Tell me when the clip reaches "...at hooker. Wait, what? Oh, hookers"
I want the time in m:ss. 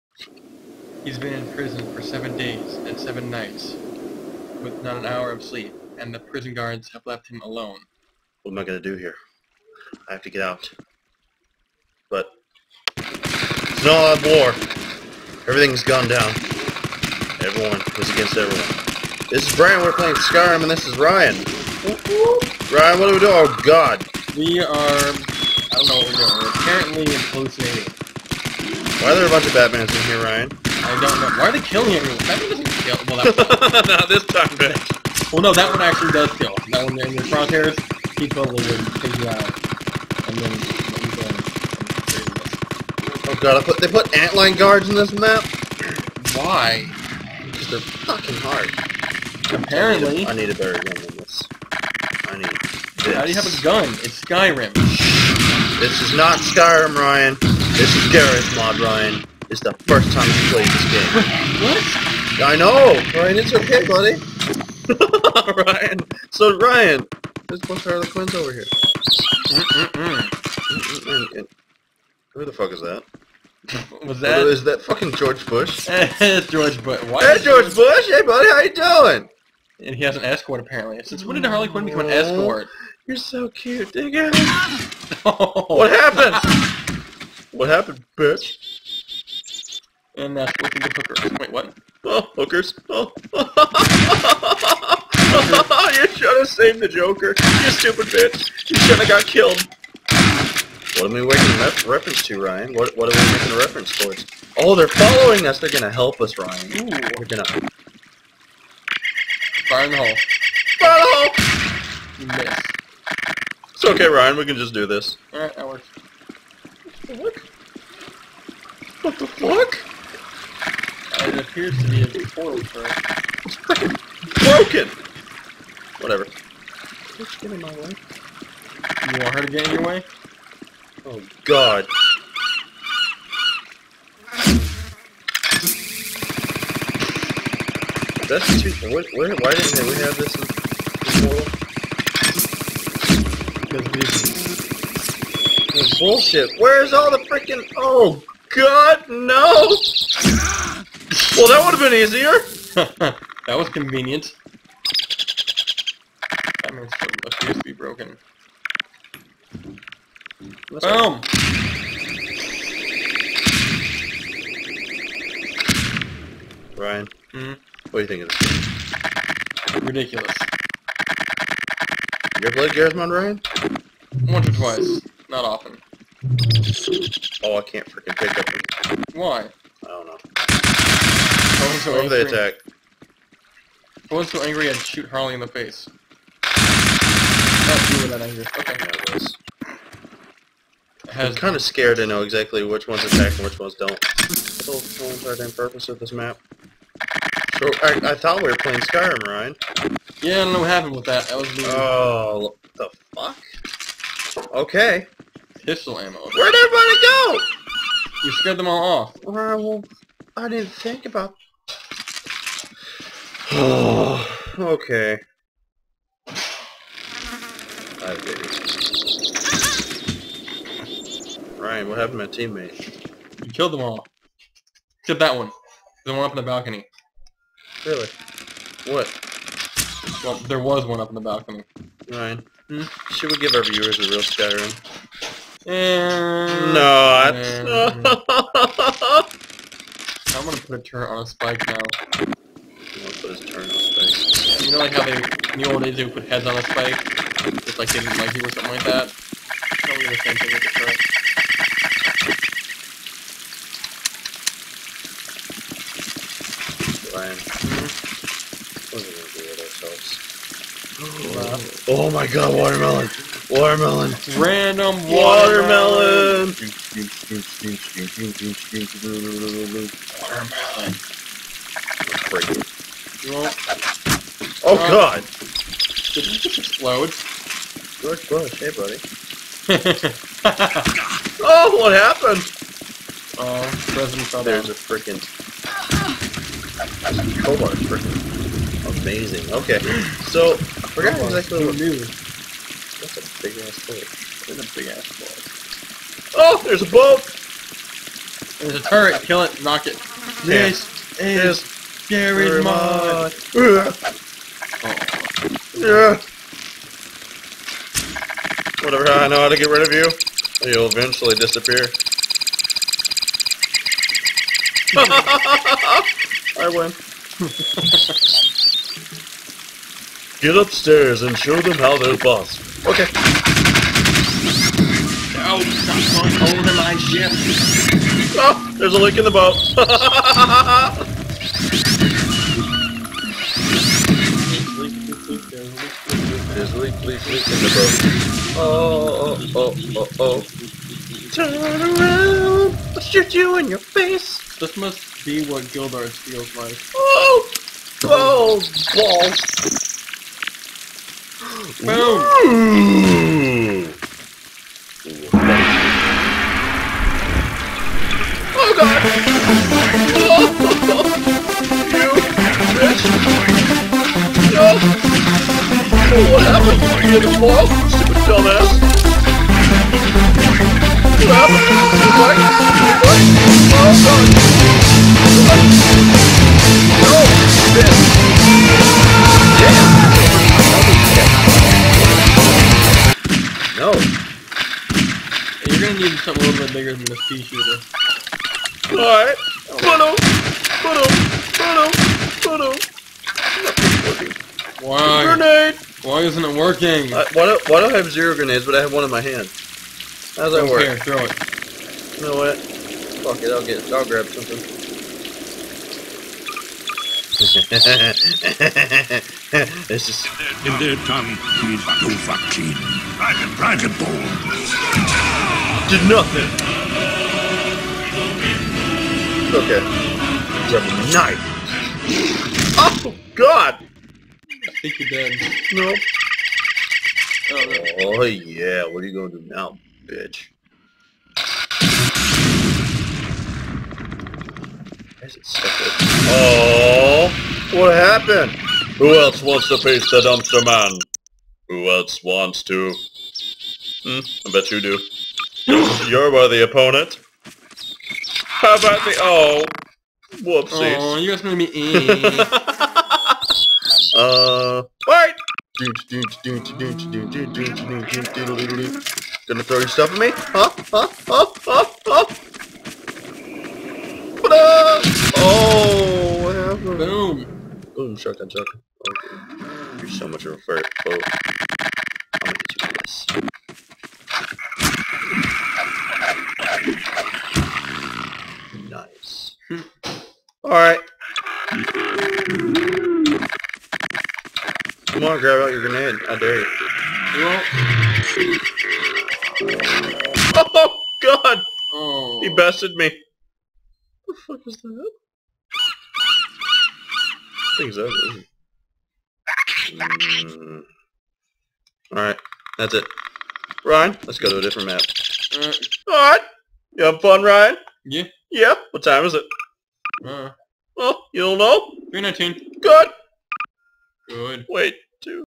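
1:30.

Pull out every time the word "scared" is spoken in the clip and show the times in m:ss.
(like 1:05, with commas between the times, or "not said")
3:11, 3:28.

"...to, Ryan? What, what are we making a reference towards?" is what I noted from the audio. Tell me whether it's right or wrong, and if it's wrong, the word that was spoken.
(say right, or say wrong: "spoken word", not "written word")
right.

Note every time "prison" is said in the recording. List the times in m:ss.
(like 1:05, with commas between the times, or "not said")
0:01, 0:06.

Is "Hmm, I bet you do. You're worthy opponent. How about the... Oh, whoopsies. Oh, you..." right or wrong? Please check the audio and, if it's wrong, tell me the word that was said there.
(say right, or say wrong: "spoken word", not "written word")
right.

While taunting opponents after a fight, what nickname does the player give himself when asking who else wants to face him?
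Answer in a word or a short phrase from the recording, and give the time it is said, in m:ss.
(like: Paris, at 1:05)
The dumpster man, at 7:20.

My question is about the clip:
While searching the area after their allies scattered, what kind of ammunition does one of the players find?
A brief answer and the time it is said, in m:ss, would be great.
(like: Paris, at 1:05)
Pistol ammo, at 3:25.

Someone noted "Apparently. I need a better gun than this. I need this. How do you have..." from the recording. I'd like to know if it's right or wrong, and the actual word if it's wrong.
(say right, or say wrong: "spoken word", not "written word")
right.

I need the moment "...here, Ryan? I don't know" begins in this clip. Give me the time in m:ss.
0:30.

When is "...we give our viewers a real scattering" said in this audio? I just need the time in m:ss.
3:53.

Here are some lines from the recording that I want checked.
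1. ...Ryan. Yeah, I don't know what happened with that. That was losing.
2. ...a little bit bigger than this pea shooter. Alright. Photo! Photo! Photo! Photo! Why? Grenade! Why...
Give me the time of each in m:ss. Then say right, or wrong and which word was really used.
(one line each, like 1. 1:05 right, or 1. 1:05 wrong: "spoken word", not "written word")
1. 3:19 right
2. 6:26 right.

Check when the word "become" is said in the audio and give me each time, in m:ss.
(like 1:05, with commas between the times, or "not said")
1:21.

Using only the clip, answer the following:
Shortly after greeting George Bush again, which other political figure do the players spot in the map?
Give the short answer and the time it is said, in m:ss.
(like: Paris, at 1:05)
President Trump, at 4:43.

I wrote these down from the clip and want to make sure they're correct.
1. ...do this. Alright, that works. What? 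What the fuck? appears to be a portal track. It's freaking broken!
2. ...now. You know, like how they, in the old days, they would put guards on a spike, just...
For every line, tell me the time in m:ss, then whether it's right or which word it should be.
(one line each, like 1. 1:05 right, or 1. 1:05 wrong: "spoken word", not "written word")
1. 1:54 right
2. 4:01 wrong: "heads", not "guards".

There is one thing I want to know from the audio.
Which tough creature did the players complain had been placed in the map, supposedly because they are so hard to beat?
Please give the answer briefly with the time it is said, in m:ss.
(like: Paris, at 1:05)
Antlion guards, at 0:44.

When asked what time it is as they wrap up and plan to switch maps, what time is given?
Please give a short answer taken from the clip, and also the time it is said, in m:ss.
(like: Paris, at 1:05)
3:19, at 8:32.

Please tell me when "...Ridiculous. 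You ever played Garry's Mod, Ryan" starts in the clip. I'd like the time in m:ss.
2:49.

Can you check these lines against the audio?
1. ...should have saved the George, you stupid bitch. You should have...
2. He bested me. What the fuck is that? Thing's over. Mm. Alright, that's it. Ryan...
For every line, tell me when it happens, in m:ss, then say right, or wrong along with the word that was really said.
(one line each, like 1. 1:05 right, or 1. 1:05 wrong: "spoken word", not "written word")
1. 1:36 wrong: "Joker", not "George"
2. 8:12 right.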